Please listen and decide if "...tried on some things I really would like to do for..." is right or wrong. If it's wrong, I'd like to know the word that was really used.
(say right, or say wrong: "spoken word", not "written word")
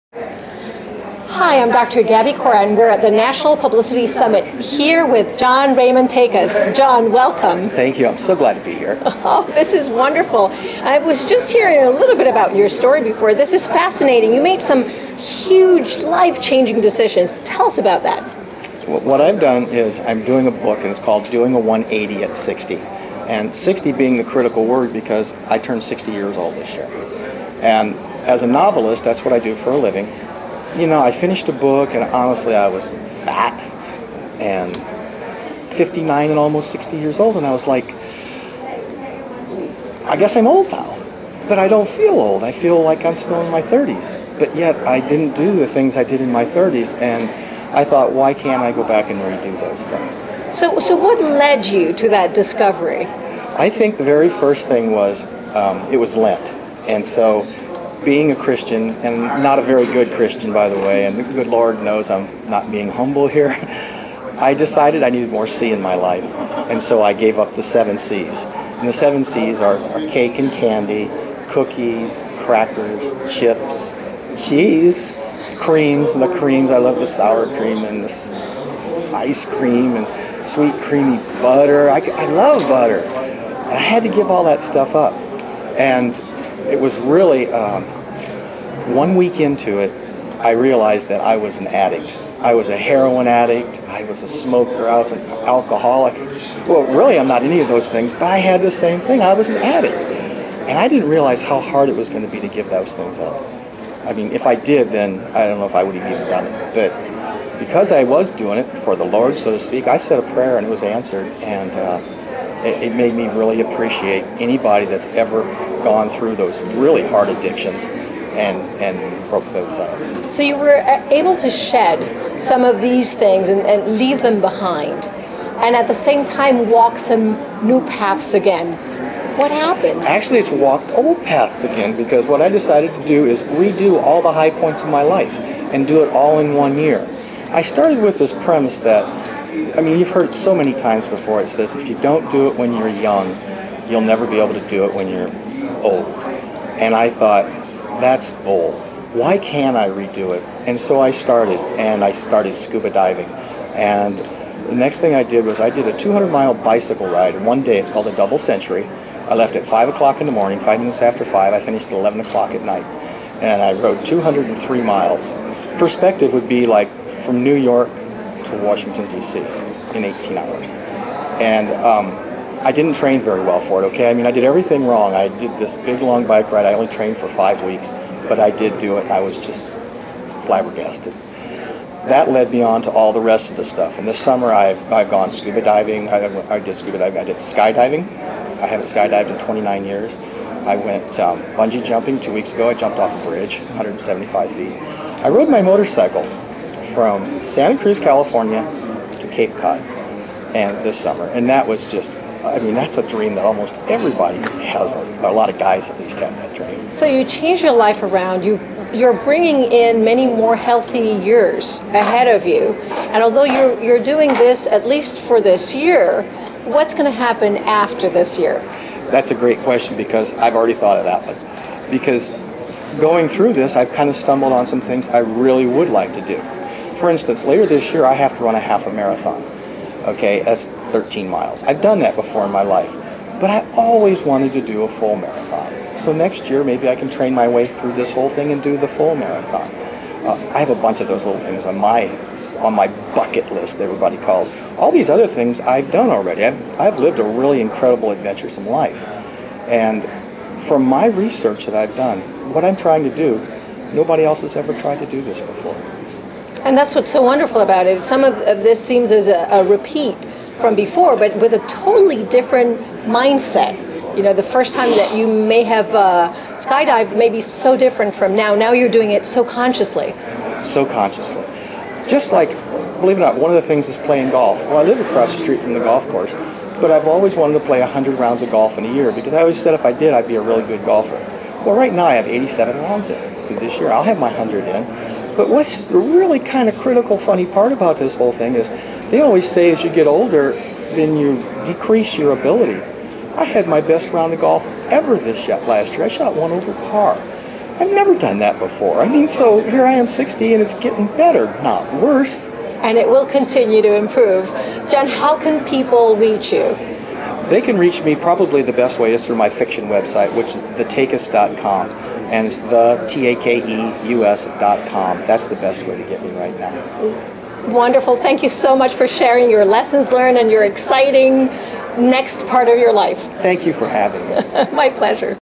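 wrong: "stumbled", not "tried".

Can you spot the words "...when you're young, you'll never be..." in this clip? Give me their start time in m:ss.
2:22.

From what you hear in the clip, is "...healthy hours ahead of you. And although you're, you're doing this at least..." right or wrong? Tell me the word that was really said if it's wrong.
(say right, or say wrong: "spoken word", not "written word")
wrong: "years", not "hours".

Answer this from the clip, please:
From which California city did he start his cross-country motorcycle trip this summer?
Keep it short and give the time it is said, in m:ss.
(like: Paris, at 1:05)
Santa Cruz, at 3:17.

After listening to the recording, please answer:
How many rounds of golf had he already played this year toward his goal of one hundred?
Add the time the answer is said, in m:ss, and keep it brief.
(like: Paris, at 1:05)
87, at 4:42.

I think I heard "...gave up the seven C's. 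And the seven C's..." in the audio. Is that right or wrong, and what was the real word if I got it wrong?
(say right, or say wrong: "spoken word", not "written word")
right.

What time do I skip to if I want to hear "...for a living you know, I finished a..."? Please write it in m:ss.
0:29.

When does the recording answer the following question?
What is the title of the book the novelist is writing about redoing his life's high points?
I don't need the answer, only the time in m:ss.
0:21.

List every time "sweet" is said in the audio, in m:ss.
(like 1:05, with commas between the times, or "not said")
1:20.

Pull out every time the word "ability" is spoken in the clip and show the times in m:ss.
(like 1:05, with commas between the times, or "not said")
4:52.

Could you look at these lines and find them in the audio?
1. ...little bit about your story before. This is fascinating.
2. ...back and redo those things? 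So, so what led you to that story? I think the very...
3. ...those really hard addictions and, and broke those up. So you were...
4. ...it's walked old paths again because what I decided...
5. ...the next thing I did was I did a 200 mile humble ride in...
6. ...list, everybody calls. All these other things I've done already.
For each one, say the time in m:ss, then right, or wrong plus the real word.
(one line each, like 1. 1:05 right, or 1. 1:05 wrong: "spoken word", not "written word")
1. 0:11 right
2. 0:48 wrong: "discovery", not "story"
3. 1:56 right
4. 2:10 right
5. 2:34 wrong: "bicycle", not "humble"
6. 4:03 right.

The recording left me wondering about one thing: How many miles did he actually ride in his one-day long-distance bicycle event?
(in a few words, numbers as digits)
203.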